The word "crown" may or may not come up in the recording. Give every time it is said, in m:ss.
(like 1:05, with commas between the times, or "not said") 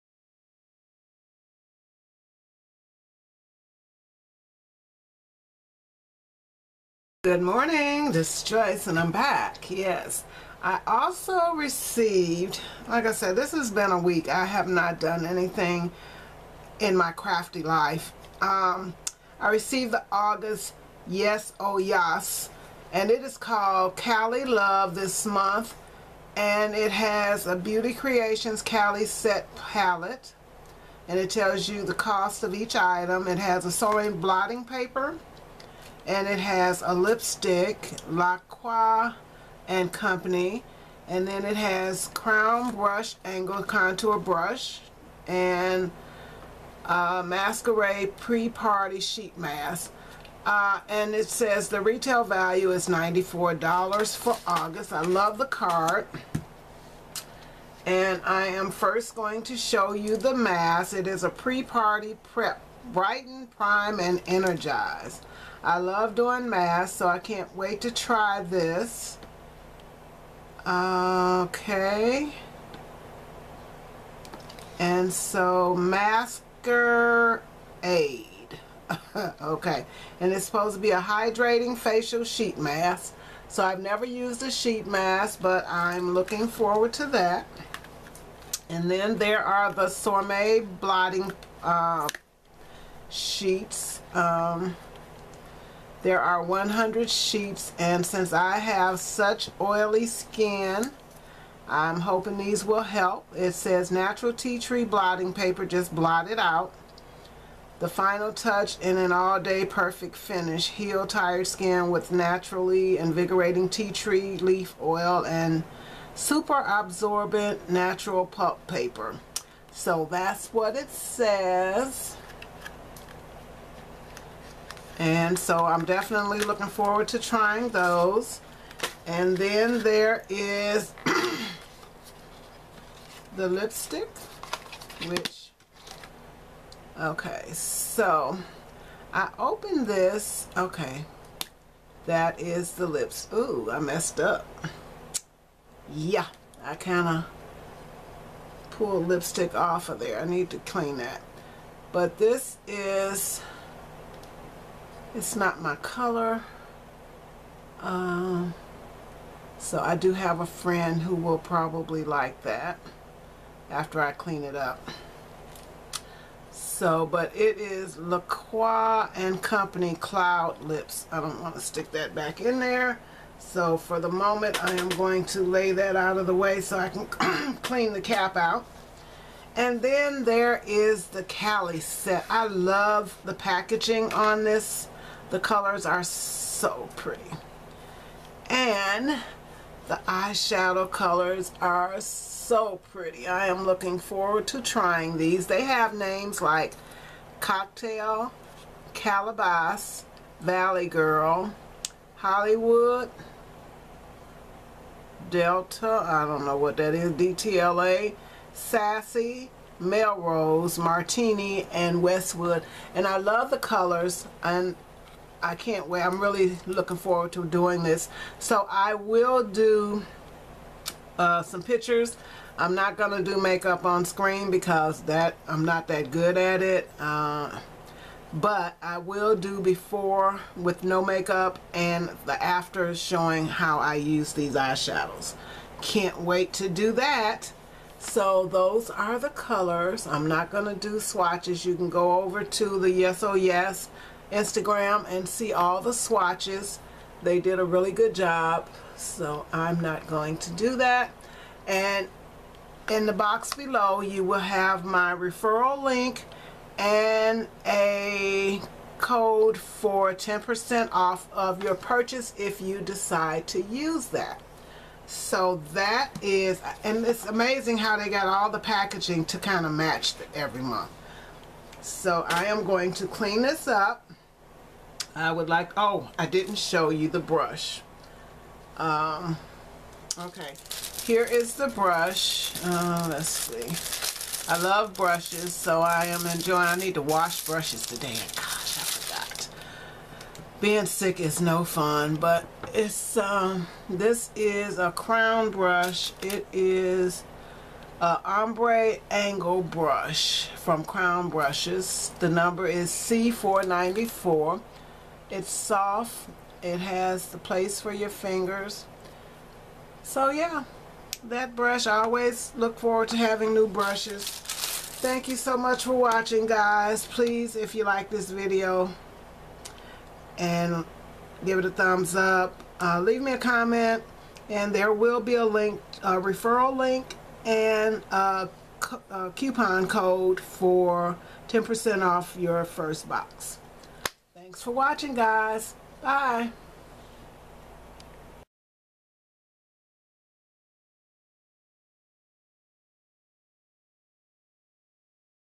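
0:42, 4:54, 5:00.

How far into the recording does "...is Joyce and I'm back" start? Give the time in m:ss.
0:08.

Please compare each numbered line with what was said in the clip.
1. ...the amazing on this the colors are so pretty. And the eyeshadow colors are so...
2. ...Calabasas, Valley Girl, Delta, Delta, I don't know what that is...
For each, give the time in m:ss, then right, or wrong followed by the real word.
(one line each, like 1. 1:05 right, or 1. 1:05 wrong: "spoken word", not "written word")
1. 3:03 wrong: "packaging", not "amazing"
2. 3:18 wrong: "Hollywood", not "Delta".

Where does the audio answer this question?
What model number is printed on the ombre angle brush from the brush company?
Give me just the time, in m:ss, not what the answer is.
5:02.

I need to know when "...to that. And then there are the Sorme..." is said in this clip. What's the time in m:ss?
1:26.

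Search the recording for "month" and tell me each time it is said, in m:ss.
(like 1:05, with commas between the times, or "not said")
0:25, 4:30.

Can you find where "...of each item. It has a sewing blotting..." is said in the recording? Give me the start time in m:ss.
0:32.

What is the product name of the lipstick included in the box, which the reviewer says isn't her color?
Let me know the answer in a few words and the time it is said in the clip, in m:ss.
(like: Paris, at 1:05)
Cloud Lips, at 2:49.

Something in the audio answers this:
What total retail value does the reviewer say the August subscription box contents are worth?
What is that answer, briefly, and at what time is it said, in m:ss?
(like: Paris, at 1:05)
$94, at 0:52.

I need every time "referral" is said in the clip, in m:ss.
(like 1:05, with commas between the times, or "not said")
4:15, 5:26.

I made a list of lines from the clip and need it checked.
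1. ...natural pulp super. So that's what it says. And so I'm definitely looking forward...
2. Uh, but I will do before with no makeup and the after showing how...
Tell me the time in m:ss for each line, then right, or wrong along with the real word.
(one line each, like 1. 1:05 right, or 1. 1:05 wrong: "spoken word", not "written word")
1. 1:57 wrong: "paper", not "super"
2. 3:46 right.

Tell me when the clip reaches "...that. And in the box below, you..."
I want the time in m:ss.
4:10.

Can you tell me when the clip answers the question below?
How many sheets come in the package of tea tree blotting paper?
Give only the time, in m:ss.
1:36.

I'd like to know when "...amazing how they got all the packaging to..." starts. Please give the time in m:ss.
4:27.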